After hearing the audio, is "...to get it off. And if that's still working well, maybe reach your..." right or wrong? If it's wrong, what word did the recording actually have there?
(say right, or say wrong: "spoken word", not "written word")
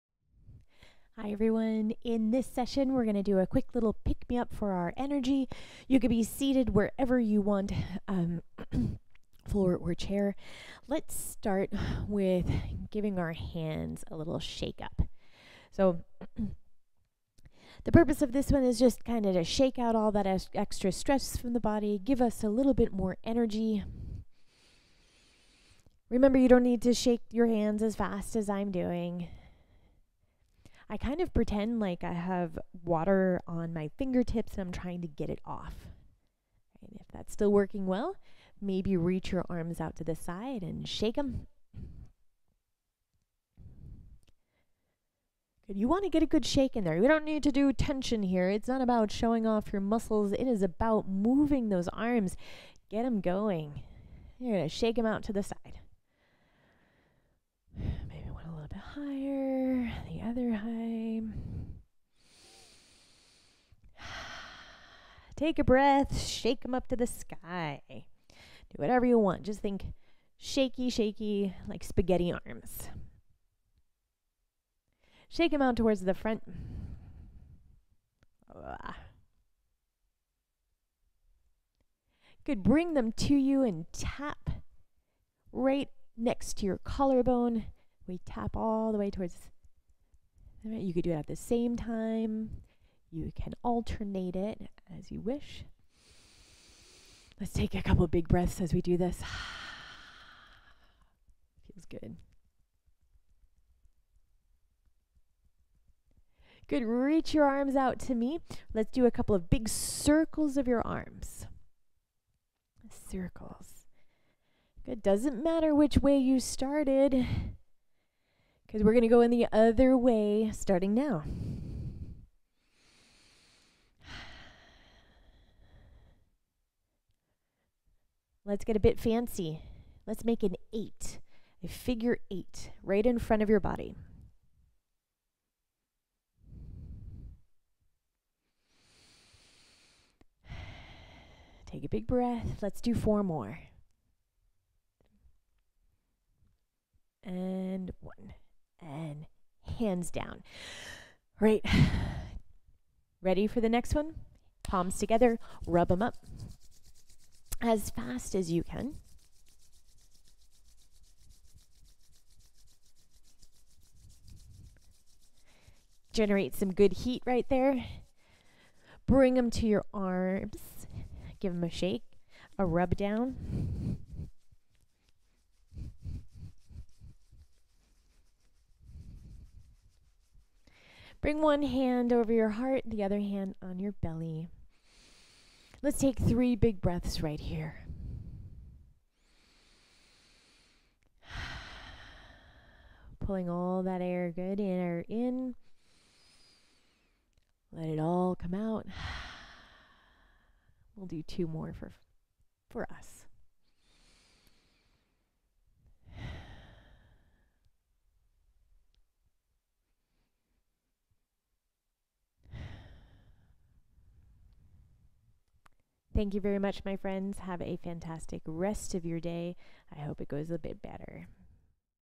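right.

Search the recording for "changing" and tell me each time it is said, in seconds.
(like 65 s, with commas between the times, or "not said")
not said.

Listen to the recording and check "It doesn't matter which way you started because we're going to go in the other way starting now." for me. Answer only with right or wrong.
right.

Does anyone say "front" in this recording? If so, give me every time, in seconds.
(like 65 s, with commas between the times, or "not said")
76 s, 133 s.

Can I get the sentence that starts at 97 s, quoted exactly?
Let's take a couple big breaths as we do this.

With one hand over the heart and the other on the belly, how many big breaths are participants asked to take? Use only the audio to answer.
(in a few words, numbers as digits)
3.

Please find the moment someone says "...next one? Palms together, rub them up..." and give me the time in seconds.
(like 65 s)
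153 s.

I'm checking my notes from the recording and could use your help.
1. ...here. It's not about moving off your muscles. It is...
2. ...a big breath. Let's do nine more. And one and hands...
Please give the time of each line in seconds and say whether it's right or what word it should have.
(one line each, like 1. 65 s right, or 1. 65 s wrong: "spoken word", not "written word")
1. 48 s wrong: "showing", not "moving"
2. 141 s wrong: "four", not "nine".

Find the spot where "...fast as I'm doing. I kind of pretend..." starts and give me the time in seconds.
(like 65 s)
27 s.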